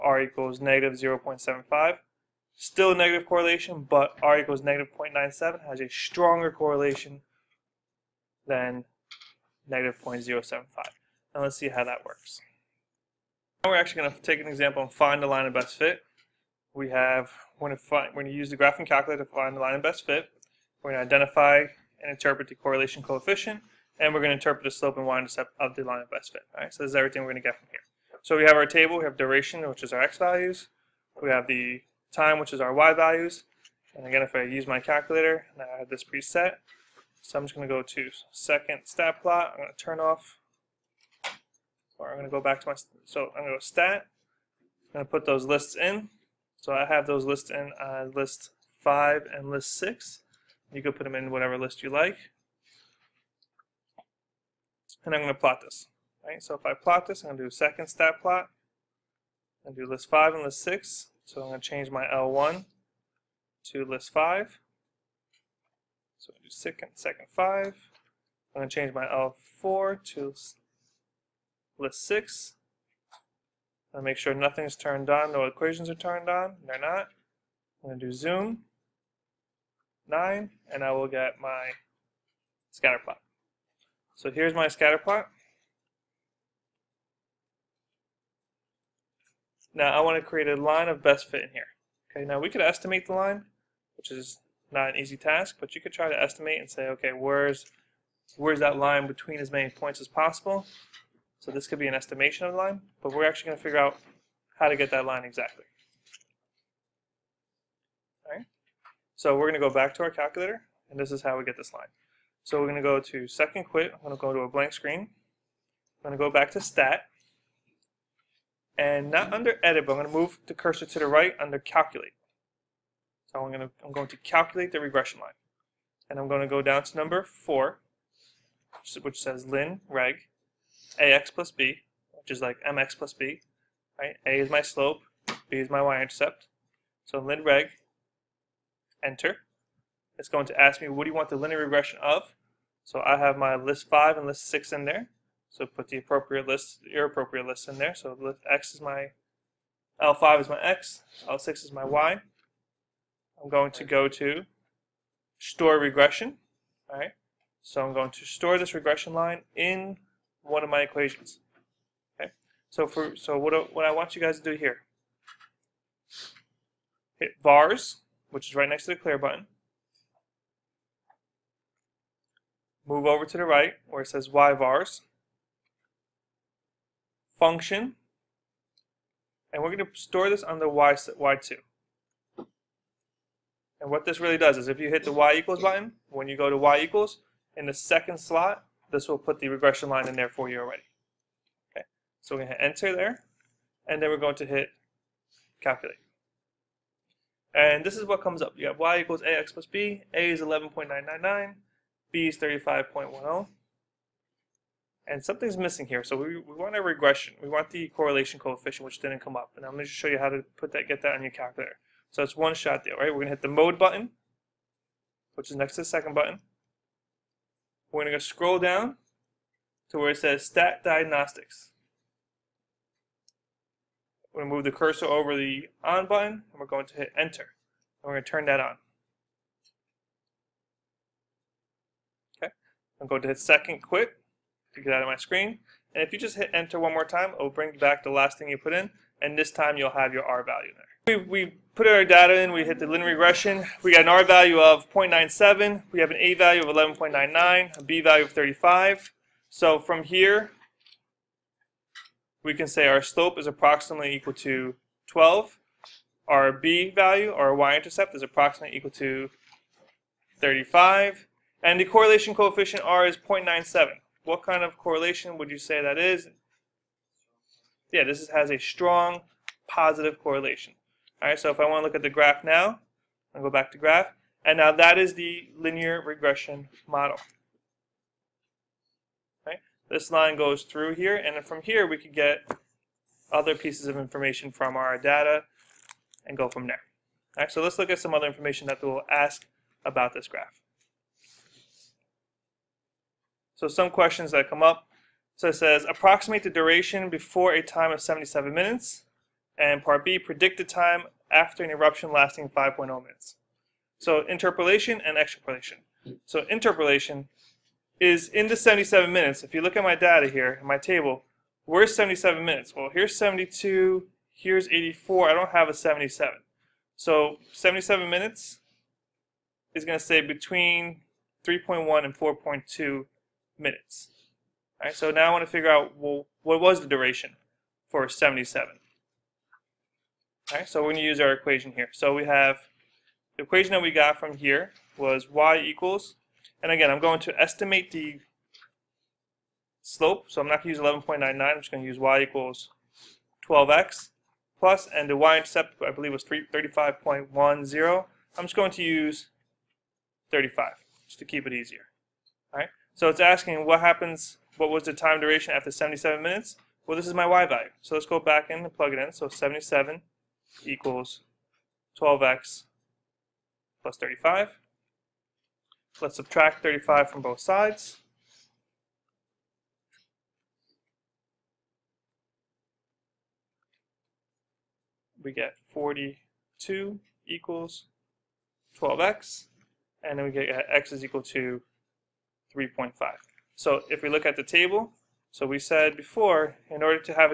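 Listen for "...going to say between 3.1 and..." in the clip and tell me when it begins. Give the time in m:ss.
5:19.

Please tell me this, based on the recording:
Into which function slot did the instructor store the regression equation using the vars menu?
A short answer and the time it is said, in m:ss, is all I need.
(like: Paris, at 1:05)
Y2, at 3:00.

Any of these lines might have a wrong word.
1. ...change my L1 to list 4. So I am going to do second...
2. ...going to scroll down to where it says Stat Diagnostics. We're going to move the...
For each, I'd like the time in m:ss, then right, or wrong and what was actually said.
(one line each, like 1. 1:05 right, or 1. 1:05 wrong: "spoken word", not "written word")
1. 1:01 wrong: "5", not "4"
2. 3:38 right.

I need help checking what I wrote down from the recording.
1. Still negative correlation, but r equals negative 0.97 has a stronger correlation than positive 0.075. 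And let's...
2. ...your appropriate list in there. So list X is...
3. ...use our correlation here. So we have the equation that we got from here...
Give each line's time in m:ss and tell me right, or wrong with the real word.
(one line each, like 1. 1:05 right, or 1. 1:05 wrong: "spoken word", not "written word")
1. 0:02 wrong: "negative", not "positive"
2. 2:26 right
3. 5:31 wrong: "equation", not "correlation".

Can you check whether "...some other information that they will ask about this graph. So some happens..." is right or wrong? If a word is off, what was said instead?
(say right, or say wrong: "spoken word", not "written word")
wrong: "questions", not "happens".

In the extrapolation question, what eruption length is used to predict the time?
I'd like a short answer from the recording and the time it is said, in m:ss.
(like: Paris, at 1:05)
5.0 minutes, at 5:02.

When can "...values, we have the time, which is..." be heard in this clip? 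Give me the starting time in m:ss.
0:30.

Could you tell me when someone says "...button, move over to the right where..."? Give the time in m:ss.
2:49.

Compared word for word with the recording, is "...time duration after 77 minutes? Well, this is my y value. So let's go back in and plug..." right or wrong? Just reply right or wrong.
right.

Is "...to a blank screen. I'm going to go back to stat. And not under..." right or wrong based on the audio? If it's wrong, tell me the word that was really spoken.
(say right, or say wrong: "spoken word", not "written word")
right.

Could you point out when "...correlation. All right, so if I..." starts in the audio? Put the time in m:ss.
4:30.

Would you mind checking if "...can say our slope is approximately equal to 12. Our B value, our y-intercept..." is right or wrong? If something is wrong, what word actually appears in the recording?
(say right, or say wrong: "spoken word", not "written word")
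right.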